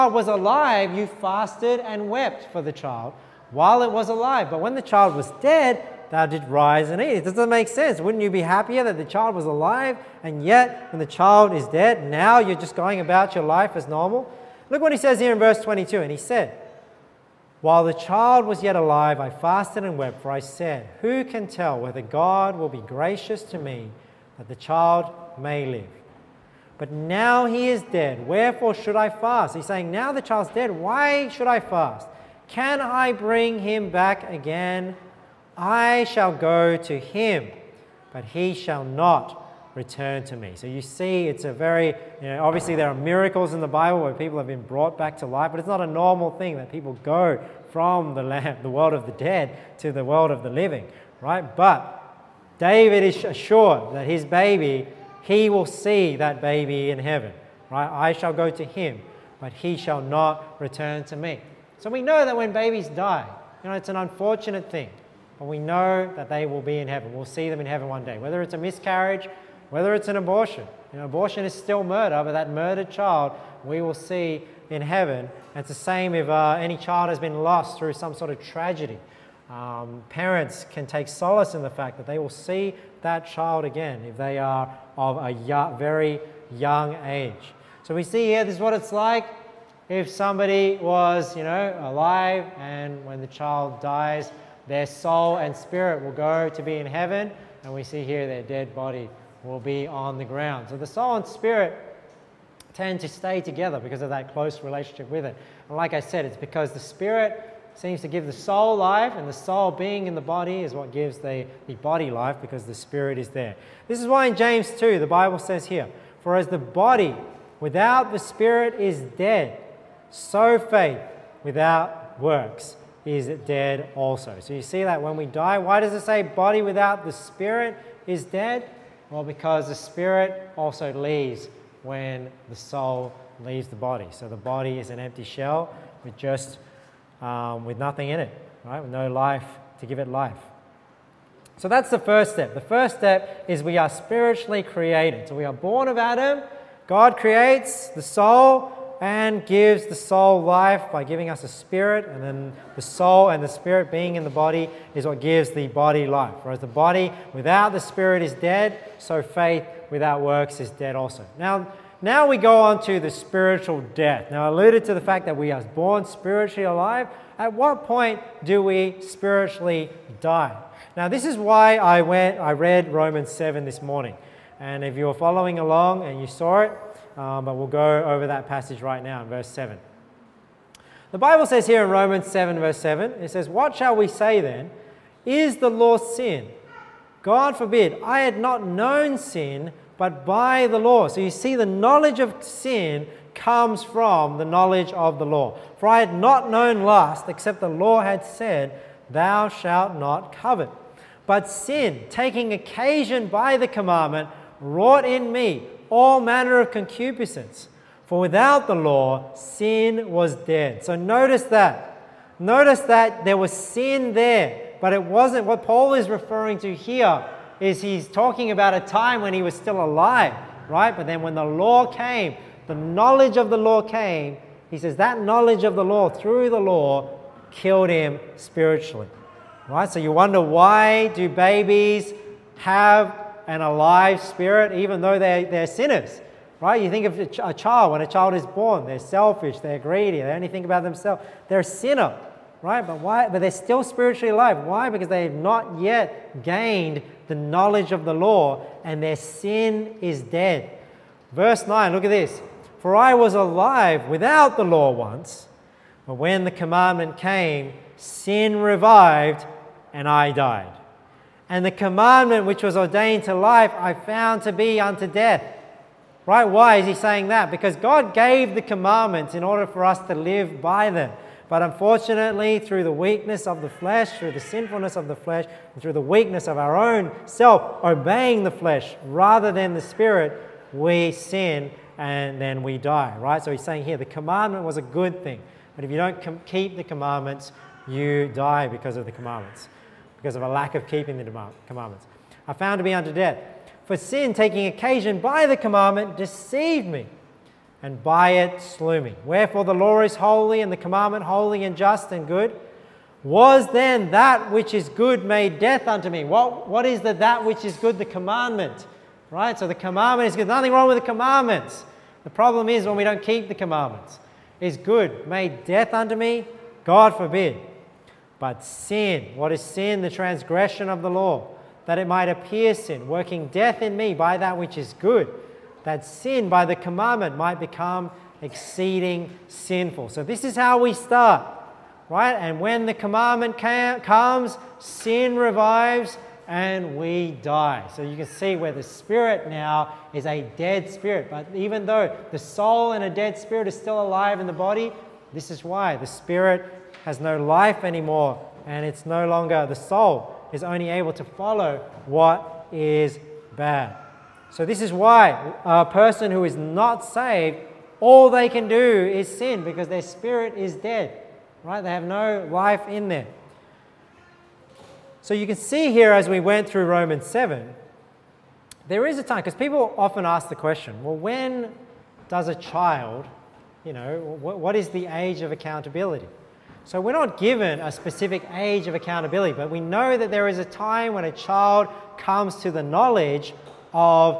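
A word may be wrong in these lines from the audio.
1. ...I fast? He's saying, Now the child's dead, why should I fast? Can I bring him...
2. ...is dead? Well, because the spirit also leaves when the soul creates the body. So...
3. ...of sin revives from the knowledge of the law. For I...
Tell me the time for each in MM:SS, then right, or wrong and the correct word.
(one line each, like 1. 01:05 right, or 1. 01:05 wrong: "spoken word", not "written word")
1. 00:28 right
2. 02:08 wrong: "leaves", not "creates"
3. 03:12 wrong: "comes", not "revives".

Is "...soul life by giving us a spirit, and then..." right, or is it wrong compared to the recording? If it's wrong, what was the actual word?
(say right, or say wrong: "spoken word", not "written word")
right.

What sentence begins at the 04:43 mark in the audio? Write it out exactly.
So he's saying here the commandment was a good thing.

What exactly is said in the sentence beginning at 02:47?
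At what point do we spiritually die?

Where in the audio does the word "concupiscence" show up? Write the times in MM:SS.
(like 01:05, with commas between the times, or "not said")
03:26.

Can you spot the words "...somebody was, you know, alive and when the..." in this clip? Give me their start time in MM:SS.
01:30.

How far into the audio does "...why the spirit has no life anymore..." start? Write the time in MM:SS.
05:45.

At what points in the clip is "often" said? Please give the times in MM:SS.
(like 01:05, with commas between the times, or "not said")
06:09.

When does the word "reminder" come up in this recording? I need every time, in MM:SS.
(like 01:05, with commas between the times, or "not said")
not said.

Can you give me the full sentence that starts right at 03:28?
For without the law, sin was dead.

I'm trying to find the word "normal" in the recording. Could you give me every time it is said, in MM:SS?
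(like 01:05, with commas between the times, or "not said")
00:13, 00:45.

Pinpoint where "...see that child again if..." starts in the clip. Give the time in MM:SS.
01:22.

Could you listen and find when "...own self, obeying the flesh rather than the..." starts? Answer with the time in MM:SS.
04:36.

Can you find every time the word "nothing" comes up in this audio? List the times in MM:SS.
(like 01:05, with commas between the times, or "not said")
02:17, 05:10.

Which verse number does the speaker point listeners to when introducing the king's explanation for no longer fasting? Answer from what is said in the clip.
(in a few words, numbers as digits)
22.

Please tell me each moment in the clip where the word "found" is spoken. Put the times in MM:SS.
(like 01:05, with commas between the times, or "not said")
04:23, 04:52.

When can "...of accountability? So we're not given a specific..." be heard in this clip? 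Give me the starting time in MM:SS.
06:15.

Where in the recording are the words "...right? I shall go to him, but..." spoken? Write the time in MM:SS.
00:57.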